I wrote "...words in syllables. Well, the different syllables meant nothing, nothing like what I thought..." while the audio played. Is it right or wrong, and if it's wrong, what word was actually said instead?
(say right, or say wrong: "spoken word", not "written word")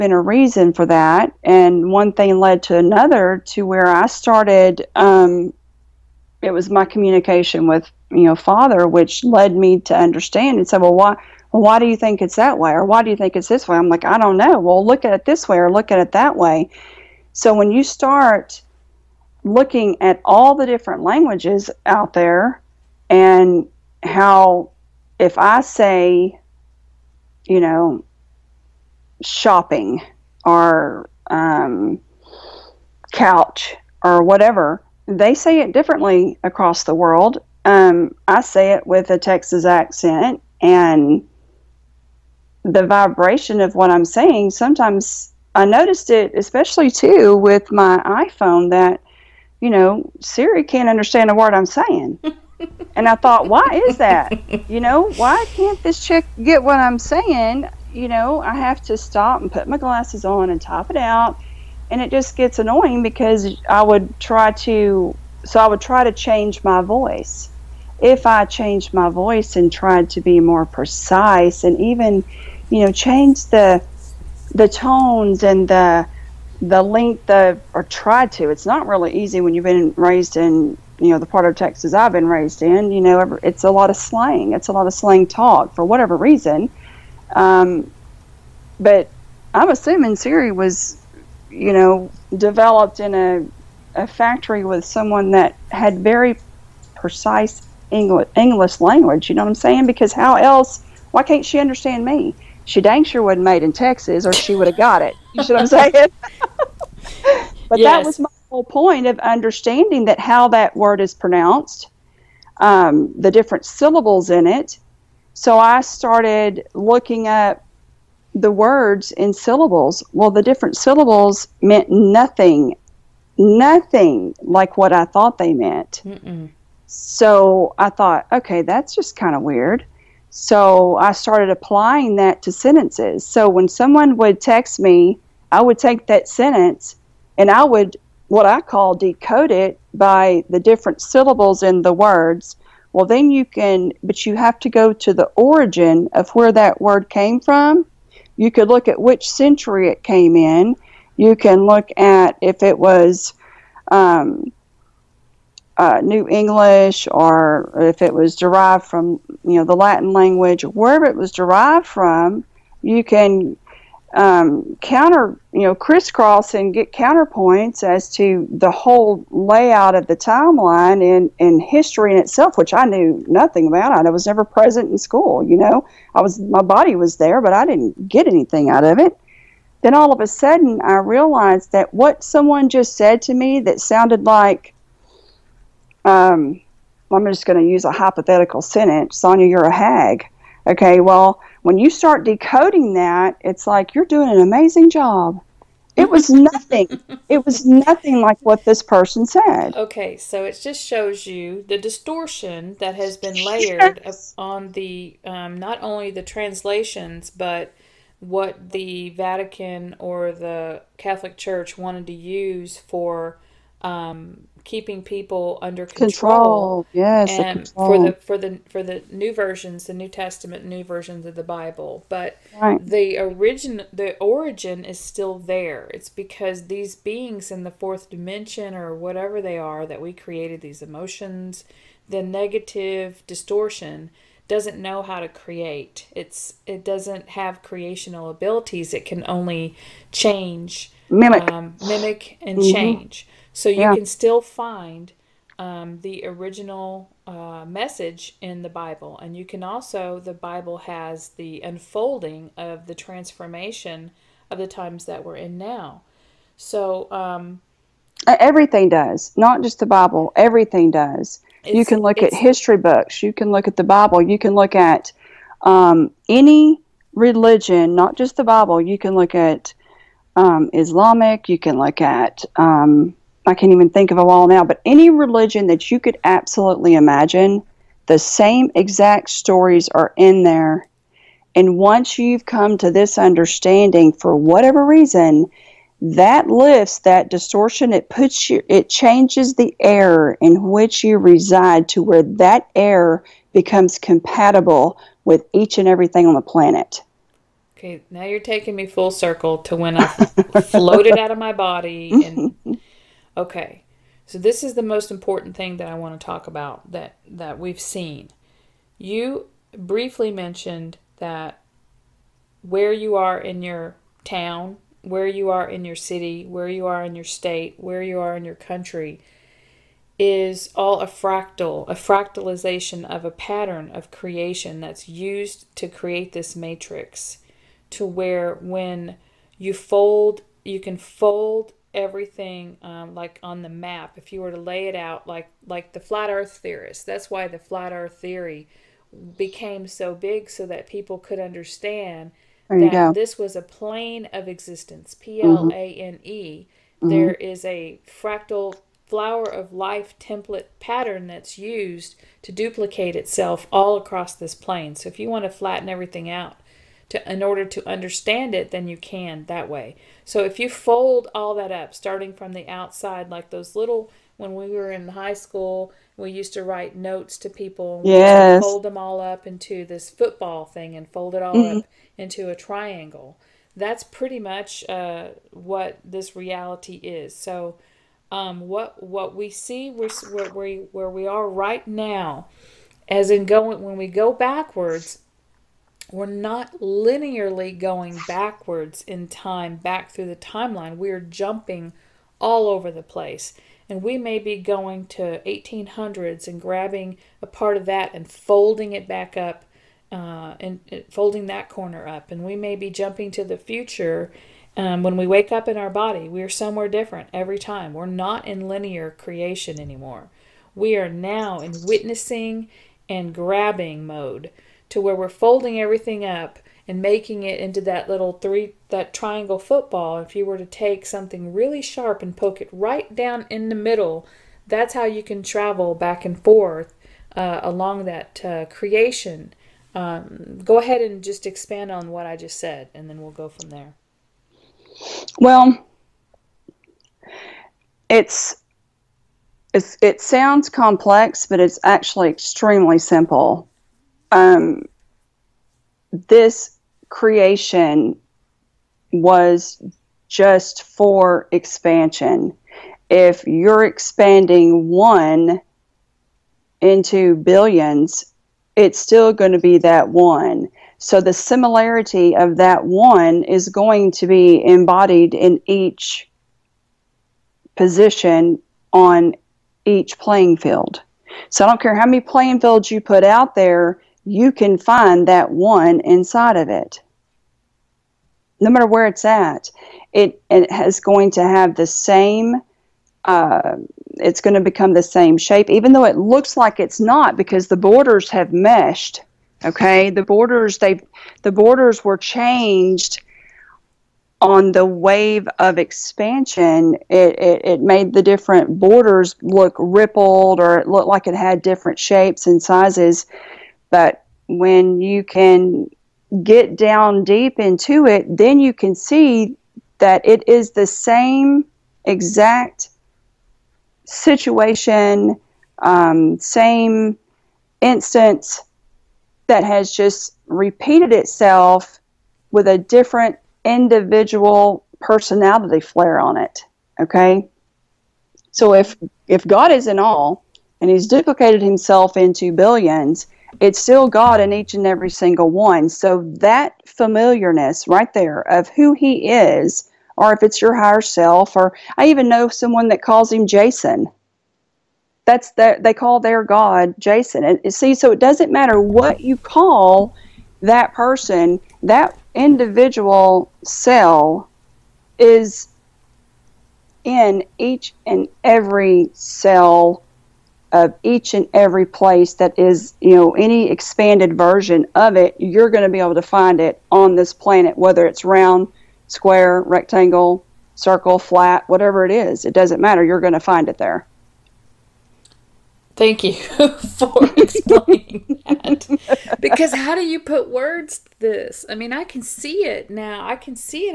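right.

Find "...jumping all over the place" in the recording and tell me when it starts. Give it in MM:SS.
06:31.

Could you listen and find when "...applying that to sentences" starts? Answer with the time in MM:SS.
02:11.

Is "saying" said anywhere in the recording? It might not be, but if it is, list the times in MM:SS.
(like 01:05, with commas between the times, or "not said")
00:44, 00:51, 00:56, 01:39, 01:45.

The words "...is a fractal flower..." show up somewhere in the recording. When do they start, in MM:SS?
05:47.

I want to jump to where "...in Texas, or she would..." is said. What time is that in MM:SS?
01:43.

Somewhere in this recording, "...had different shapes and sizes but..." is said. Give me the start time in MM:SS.
08:21.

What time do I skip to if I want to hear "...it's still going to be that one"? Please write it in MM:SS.
07:38.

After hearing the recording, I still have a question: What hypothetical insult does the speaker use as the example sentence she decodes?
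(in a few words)
You're a hag.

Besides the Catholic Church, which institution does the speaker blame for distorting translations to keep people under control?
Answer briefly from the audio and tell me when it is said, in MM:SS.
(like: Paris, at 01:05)
The Vatican, at 03:28.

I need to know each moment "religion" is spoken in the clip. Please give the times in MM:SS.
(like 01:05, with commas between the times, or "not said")
04:27, 04:35.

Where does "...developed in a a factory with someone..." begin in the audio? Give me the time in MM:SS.
01:32.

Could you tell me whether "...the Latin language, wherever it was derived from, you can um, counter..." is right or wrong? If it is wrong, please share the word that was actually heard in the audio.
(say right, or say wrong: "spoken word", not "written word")
right.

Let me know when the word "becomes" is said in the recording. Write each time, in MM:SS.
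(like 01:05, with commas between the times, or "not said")
04:53, 08:04.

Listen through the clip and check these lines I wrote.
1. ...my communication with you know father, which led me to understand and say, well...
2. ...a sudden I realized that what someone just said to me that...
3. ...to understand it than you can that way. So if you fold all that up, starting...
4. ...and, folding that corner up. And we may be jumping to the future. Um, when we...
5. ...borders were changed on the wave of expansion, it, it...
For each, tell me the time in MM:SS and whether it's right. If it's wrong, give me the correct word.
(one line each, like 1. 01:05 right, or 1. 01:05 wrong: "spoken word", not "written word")
1. 00:06 right
2. 03:00 right
3. 05:57 right
4. 06:40 right
5. 08:11 right.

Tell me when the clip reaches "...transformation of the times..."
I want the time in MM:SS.
04:12.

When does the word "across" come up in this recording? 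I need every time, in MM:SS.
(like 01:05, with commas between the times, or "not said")
00:36, 05:53.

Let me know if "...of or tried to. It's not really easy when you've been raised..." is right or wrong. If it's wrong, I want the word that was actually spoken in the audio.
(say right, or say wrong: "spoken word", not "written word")
right.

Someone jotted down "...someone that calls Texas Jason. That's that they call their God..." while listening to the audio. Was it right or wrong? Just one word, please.
wrong.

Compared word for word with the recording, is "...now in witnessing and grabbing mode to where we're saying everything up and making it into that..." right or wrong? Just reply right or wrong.
wrong.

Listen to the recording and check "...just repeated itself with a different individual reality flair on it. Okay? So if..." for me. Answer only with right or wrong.
wrong.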